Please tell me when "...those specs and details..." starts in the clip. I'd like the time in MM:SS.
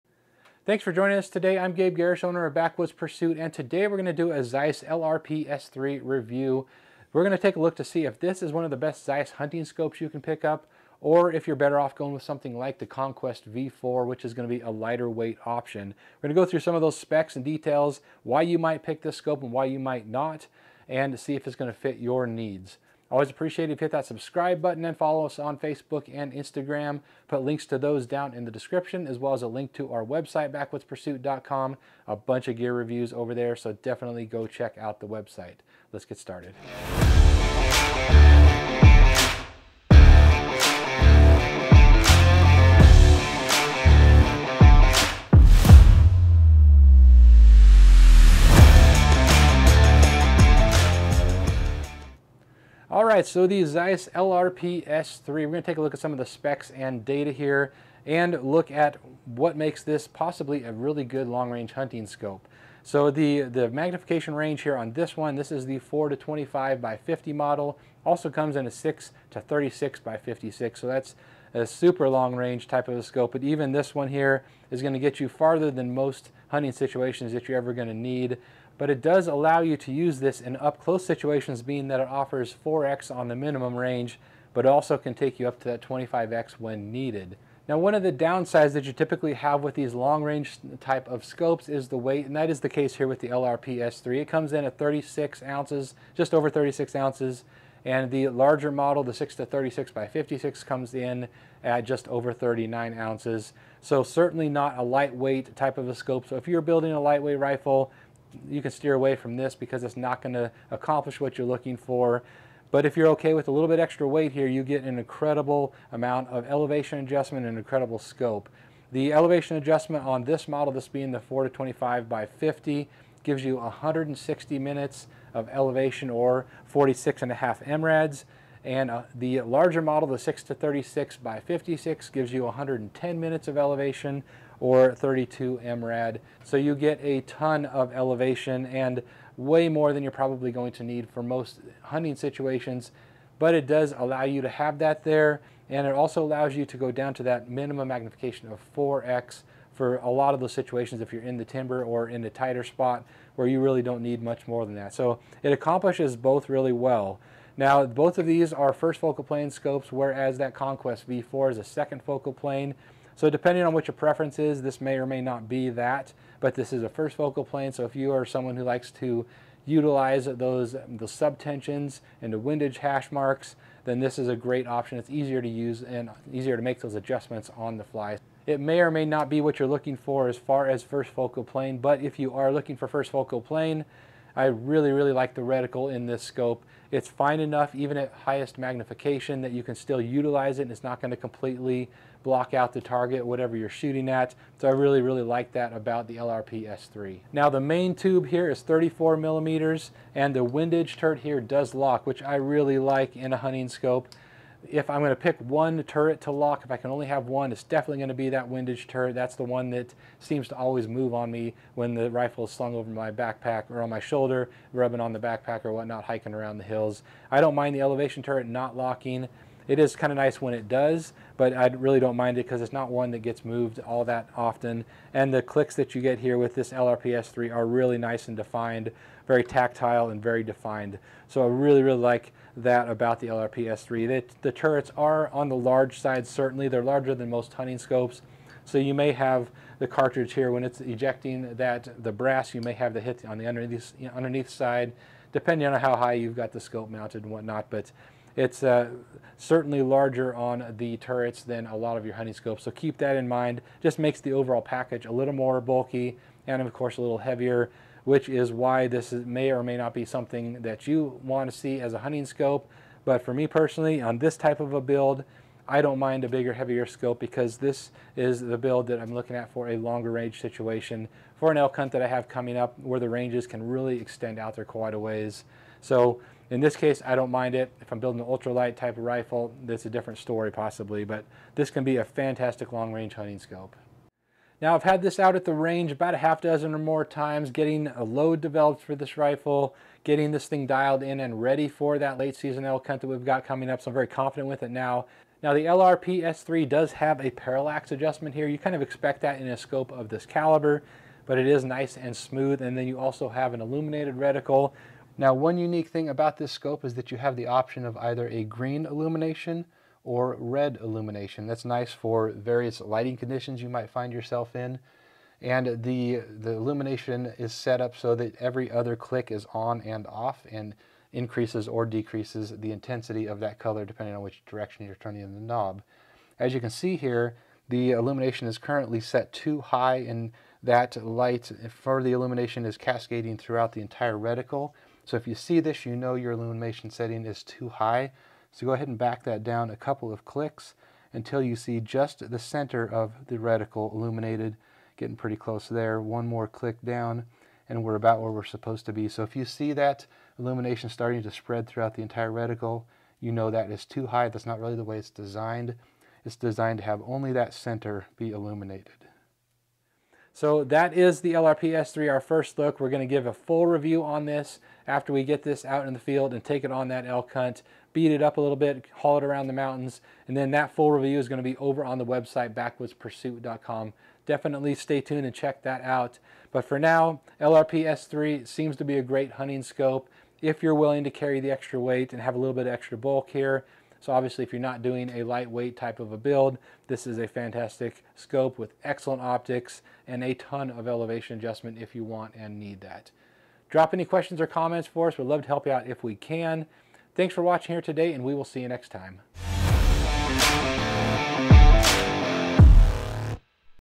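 00:16.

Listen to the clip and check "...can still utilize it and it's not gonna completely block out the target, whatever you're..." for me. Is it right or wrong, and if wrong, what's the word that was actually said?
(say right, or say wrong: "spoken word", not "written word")
right.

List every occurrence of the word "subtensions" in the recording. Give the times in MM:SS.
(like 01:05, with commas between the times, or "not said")
02:51.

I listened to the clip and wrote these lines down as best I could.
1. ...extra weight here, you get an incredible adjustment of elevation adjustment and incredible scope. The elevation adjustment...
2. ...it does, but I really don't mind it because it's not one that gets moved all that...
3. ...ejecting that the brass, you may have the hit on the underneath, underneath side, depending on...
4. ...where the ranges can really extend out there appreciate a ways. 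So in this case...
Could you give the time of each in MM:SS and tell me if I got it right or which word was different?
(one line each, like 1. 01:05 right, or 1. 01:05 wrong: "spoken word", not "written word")
1. 01:53 wrong: "amount", not "adjustment"
2. 03:40 right
3. 04:00 right
4. 04:32 wrong: "quite", not "appreciate".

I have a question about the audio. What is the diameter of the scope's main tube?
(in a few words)
34 millimeters.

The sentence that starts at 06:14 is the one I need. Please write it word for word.
Definitely stay tuned and check that out.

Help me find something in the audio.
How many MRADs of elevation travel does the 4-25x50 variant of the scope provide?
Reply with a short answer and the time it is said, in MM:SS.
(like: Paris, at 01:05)
46.5 MRADs, at 02:06.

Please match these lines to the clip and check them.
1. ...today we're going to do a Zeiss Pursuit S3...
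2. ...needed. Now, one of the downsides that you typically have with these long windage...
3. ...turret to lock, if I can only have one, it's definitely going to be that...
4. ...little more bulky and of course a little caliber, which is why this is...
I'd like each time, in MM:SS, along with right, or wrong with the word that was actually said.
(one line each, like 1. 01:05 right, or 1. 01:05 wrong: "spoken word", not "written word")
1. 00:03 wrong: "LRP", not "Pursuit"
2. 01:26 wrong: "range", not "windage"
3. 03:25 right
4. 04:15 wrong: "heavier", not "caliber".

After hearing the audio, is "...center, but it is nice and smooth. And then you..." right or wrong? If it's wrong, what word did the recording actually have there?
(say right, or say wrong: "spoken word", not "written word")
wrong: "caliber", not "center".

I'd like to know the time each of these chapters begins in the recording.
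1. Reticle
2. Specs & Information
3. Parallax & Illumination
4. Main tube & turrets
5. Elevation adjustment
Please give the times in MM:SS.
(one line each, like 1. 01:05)
1. 03:07
2. 00:52
3. 04:56
4. 03:18
5. 01:58.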